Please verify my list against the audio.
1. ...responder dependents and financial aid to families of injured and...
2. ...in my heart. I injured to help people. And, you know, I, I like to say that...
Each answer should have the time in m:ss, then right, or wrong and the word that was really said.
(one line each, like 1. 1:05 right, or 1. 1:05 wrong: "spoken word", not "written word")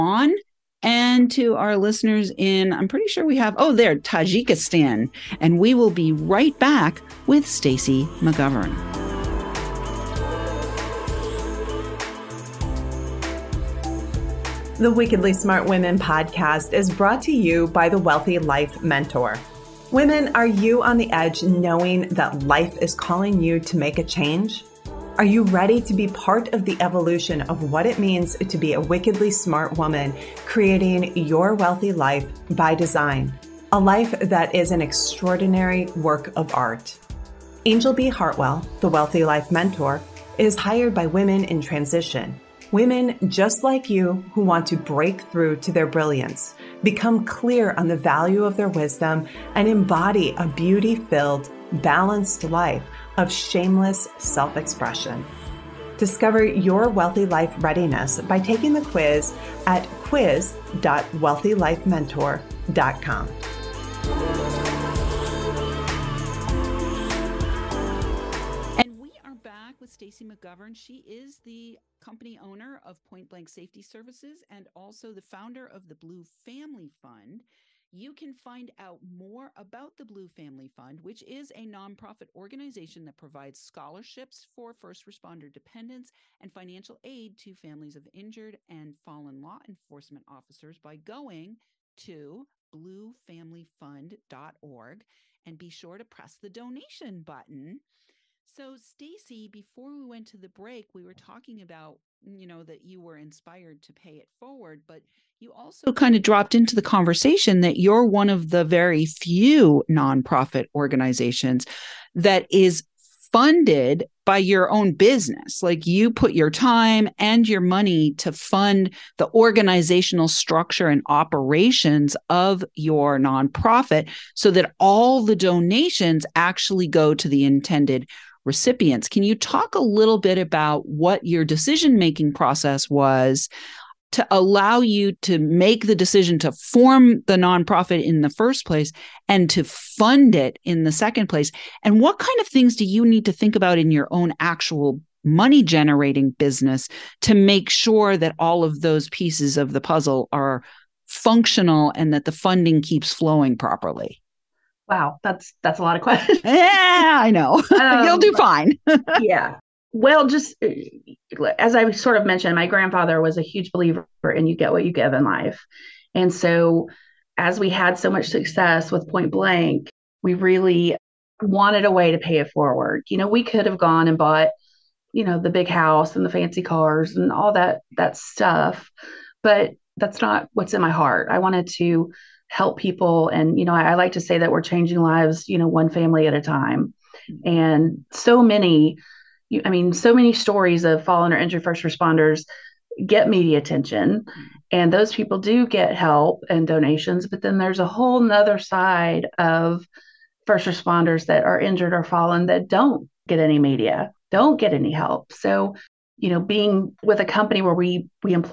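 1. 1:25 right
2. 3:00 wrong: "wanted", not "injured".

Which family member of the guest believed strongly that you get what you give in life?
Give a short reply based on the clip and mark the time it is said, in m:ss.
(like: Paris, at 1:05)
grandfather, at 2:42.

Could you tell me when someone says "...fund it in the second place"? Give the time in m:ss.
2:19.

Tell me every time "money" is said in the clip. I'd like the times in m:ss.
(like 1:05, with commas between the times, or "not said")
1:57, 2:25.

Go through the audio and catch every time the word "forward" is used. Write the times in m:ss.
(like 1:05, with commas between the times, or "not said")
1:44, 2:52.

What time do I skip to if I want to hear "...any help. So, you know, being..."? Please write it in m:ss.
3:24.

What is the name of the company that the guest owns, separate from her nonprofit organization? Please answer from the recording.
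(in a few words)
Point Blank Safety Services.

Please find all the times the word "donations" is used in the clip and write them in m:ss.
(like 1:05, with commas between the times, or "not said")
1:36, 2:05, 3:16.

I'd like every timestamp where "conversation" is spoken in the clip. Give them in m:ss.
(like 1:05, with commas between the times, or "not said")
1:46.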